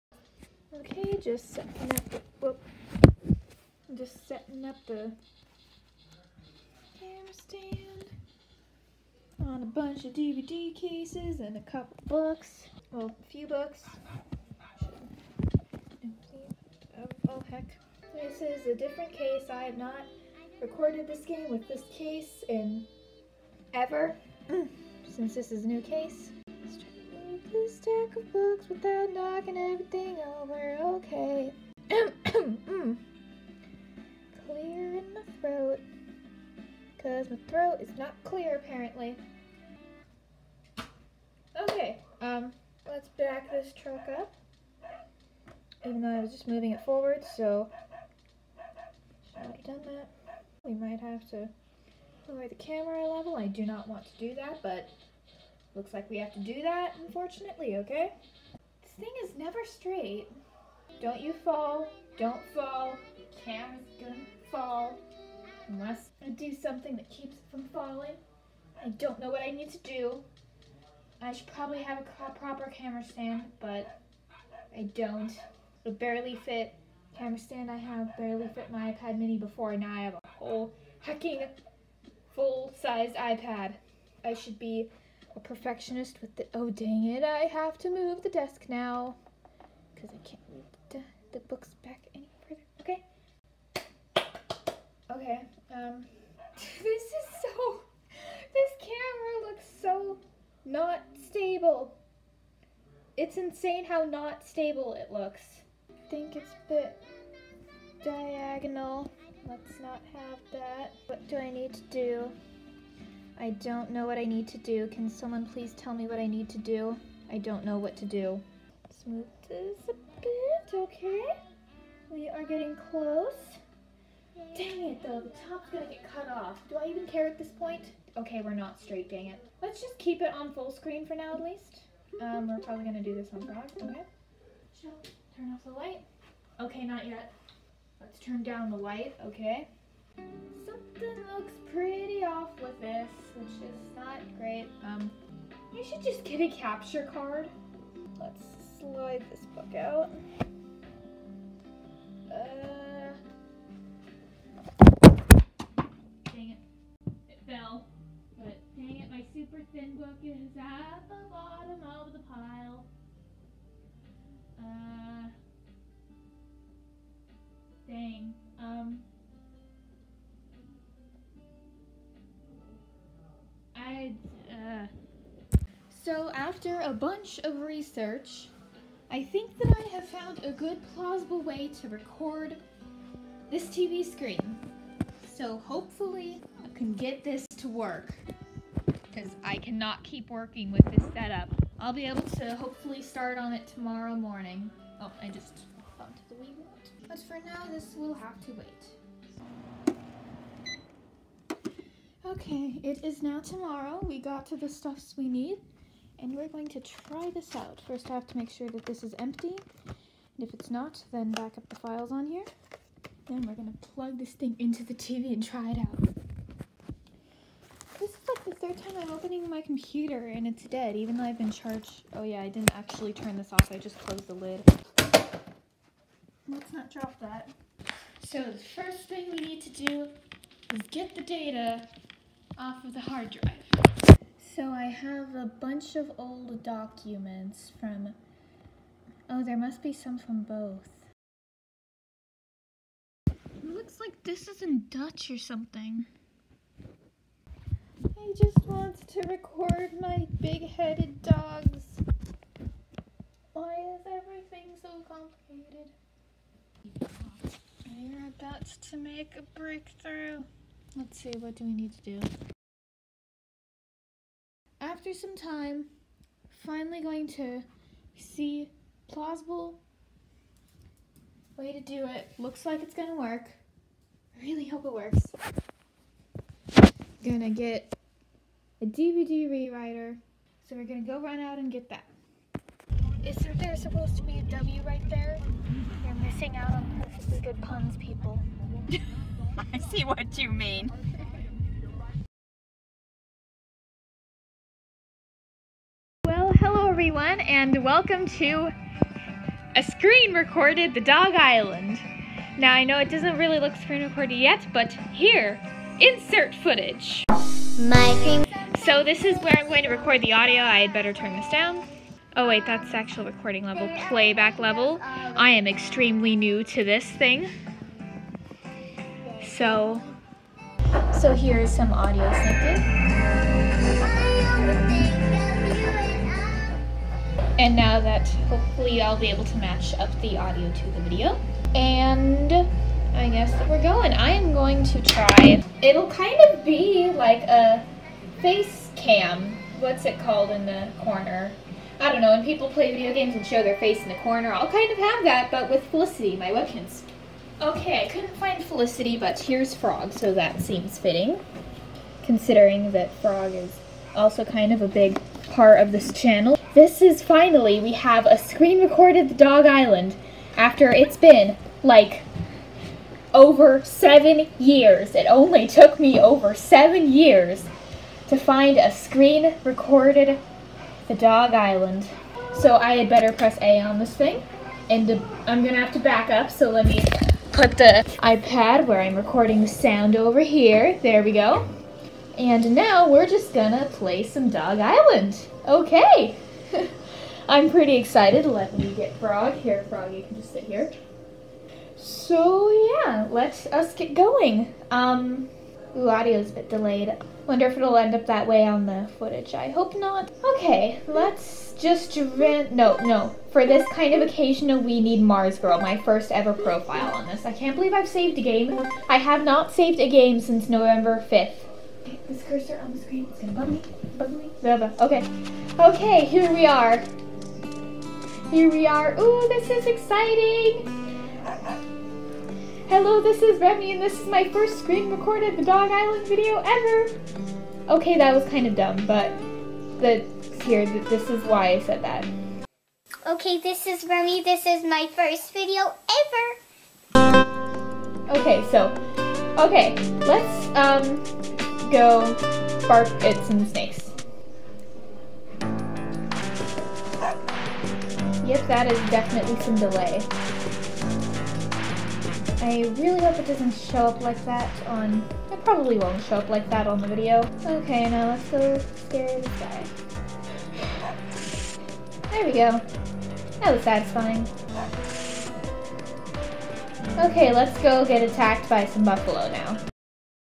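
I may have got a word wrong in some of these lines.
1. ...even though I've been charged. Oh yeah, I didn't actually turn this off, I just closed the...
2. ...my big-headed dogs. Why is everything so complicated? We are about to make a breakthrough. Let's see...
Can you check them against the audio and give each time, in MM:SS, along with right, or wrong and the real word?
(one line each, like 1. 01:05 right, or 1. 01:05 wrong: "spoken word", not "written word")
1. 03:40 right
2. 04:10 right.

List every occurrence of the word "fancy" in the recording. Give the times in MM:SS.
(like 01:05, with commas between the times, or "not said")
not said.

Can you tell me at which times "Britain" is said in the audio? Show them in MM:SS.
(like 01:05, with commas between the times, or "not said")
not said.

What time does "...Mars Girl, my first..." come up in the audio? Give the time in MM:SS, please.
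06:45.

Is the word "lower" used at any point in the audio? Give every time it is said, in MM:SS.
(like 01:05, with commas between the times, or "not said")
00:52.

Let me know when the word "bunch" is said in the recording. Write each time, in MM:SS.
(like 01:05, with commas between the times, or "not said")
00:09, 02:56, 03:55.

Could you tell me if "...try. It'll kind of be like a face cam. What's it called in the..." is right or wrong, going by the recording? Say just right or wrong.
right.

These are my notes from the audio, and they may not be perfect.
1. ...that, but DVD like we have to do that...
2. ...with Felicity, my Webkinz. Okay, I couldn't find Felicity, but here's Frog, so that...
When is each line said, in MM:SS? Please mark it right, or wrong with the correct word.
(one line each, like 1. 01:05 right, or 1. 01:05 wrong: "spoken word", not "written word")
1. 00:54 wrong: "Looks", not "DVD"
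2. 05:45 right.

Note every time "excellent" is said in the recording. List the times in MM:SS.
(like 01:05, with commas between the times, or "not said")
not said.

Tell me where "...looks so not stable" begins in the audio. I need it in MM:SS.
01:39.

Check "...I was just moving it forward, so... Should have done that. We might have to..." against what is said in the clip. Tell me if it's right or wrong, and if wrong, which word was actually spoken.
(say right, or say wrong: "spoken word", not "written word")
right.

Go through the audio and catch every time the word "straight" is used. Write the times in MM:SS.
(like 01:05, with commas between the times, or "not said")
00:59, 02:08.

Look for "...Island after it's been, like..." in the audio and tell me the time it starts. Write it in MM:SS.
05:59.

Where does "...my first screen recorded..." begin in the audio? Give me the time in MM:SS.
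07:04.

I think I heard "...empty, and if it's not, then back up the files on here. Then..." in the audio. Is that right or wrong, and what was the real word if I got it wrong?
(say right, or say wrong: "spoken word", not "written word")
right.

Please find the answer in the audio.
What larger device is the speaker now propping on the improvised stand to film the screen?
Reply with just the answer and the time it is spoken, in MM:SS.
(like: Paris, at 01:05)
full-sized iPad, at 01:22.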